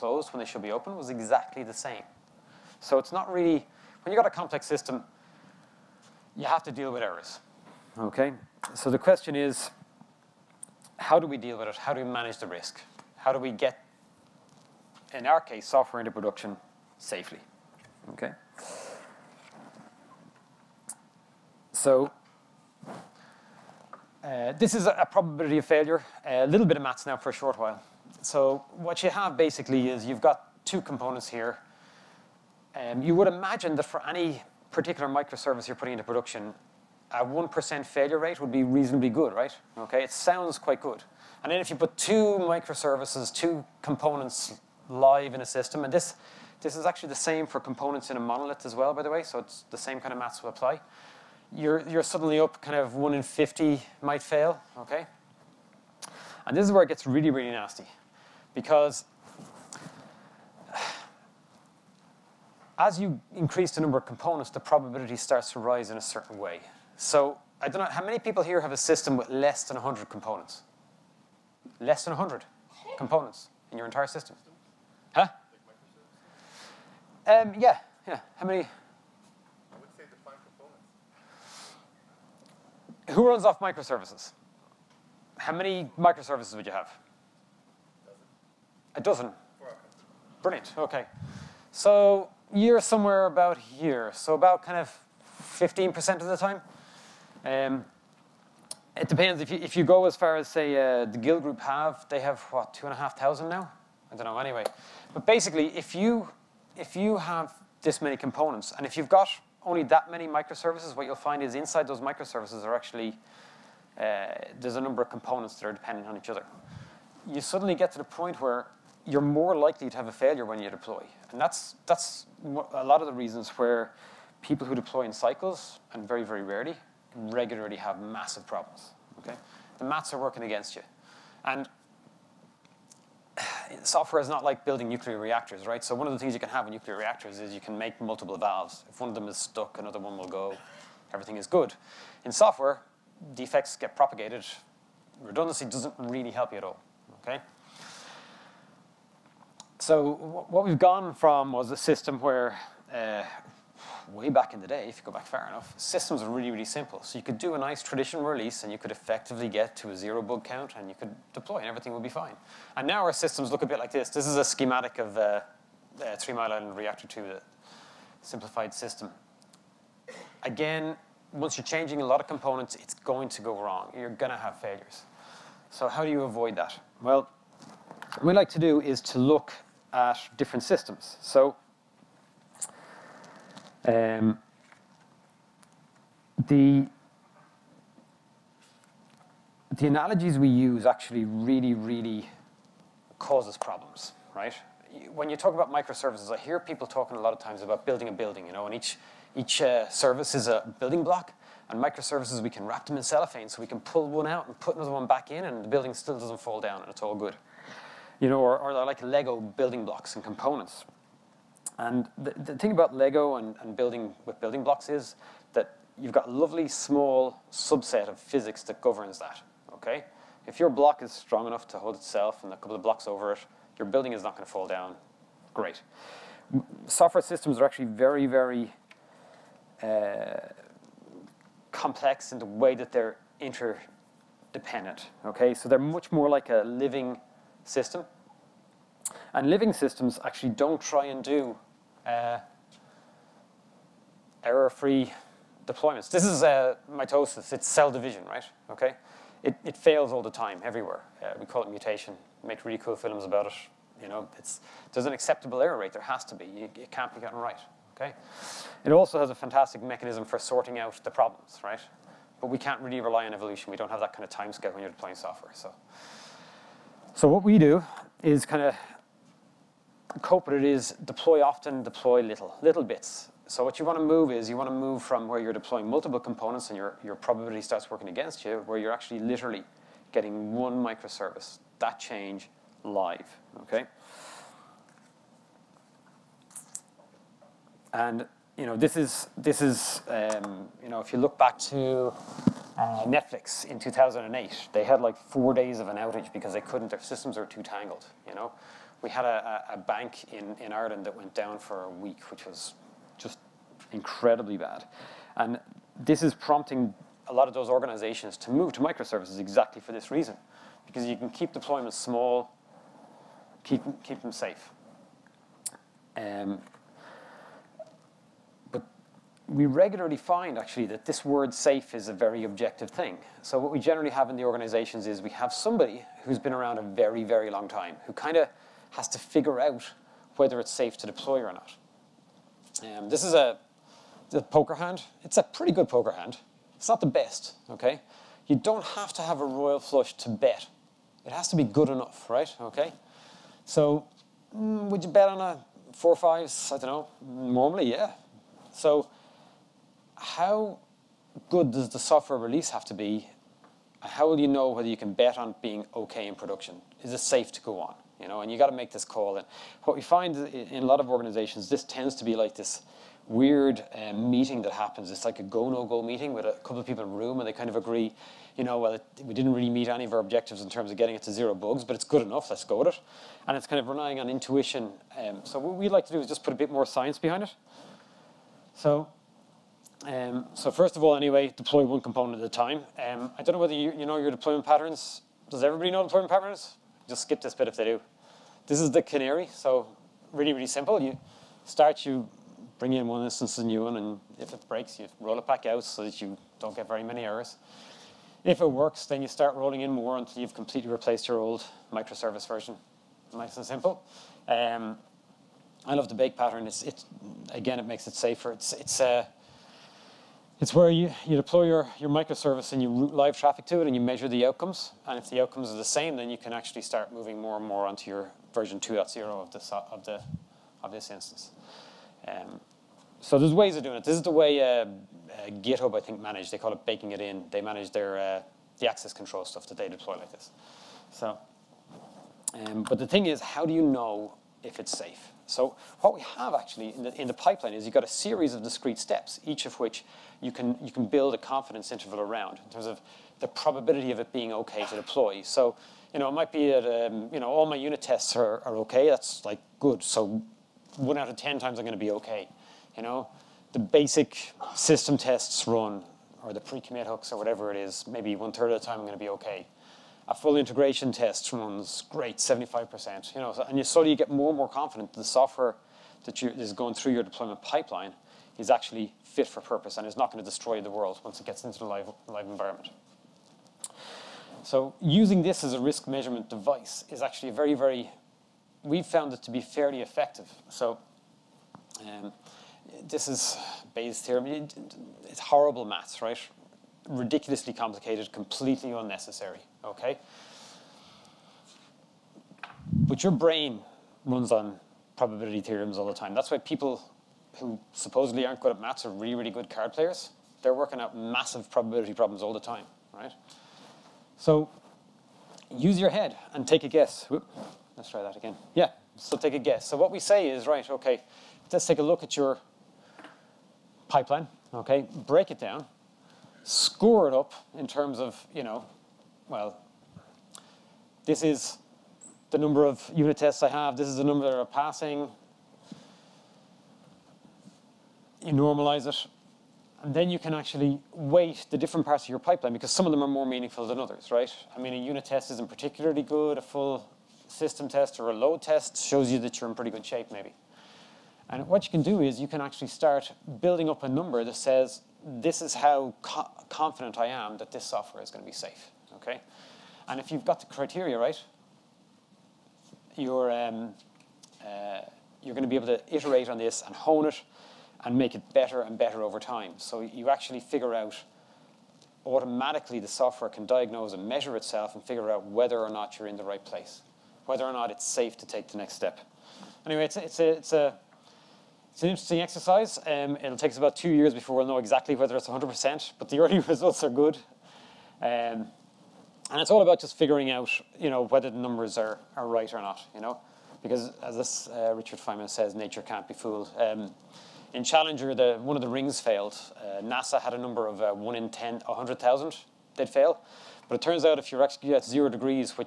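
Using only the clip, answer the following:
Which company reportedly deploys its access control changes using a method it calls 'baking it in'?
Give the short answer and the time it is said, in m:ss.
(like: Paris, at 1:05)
GitHub, at 7:05.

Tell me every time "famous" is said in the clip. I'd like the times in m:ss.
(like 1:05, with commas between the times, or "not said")
not said.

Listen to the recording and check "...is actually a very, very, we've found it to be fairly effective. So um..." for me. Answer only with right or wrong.
right.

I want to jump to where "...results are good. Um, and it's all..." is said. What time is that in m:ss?
9:36.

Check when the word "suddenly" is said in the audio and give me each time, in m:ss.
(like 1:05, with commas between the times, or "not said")
0:52, 1:57.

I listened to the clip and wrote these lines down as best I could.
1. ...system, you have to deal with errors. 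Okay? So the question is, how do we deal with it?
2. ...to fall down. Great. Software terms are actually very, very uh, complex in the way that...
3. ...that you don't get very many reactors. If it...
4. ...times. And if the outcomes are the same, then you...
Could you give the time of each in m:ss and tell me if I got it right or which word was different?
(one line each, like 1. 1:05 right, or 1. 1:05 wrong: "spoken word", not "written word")
1. 0:04 right
2. 3:44 wrong: "systems", not "terms"
3. 6:36 wrong: "errors", not "reactors"
4. 6:54 wrong: "outcomes", not "times".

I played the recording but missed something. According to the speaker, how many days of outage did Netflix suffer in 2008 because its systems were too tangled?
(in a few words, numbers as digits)
4.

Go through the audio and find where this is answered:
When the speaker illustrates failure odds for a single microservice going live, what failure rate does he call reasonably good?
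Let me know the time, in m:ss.
0:37.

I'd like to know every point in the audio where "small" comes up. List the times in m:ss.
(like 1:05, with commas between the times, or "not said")
3:36, 5:11.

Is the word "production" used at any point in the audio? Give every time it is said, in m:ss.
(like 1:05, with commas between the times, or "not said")
0:16, 0:36, 5:56.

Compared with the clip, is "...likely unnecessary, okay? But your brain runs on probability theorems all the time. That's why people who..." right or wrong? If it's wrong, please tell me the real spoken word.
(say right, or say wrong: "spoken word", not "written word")
wrong: "completely", not "likely".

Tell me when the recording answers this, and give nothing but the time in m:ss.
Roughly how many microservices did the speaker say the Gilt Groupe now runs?
1:42.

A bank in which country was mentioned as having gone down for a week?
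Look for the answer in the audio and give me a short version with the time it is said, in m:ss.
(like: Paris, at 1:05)
Ireland, at 5:00.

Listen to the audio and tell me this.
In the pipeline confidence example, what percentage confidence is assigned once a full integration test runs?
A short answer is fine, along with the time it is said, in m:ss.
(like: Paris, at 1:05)
75%, at 7:42.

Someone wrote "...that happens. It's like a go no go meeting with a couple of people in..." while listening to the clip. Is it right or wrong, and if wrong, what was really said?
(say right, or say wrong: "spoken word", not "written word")
right.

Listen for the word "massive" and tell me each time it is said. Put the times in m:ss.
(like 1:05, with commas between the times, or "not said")
2:07, 8:21.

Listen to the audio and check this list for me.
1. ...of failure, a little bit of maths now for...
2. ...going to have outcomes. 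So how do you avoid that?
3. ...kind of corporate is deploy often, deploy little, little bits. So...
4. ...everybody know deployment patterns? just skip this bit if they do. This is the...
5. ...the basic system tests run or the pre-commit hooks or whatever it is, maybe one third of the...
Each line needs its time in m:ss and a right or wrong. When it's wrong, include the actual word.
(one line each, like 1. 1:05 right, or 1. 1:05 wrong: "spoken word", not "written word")
1. 0:25 right
2. 2:54 wrong: "failures", not "outcomes"
3. 4:28 right
4. 6:25 right
5. 7:33 right.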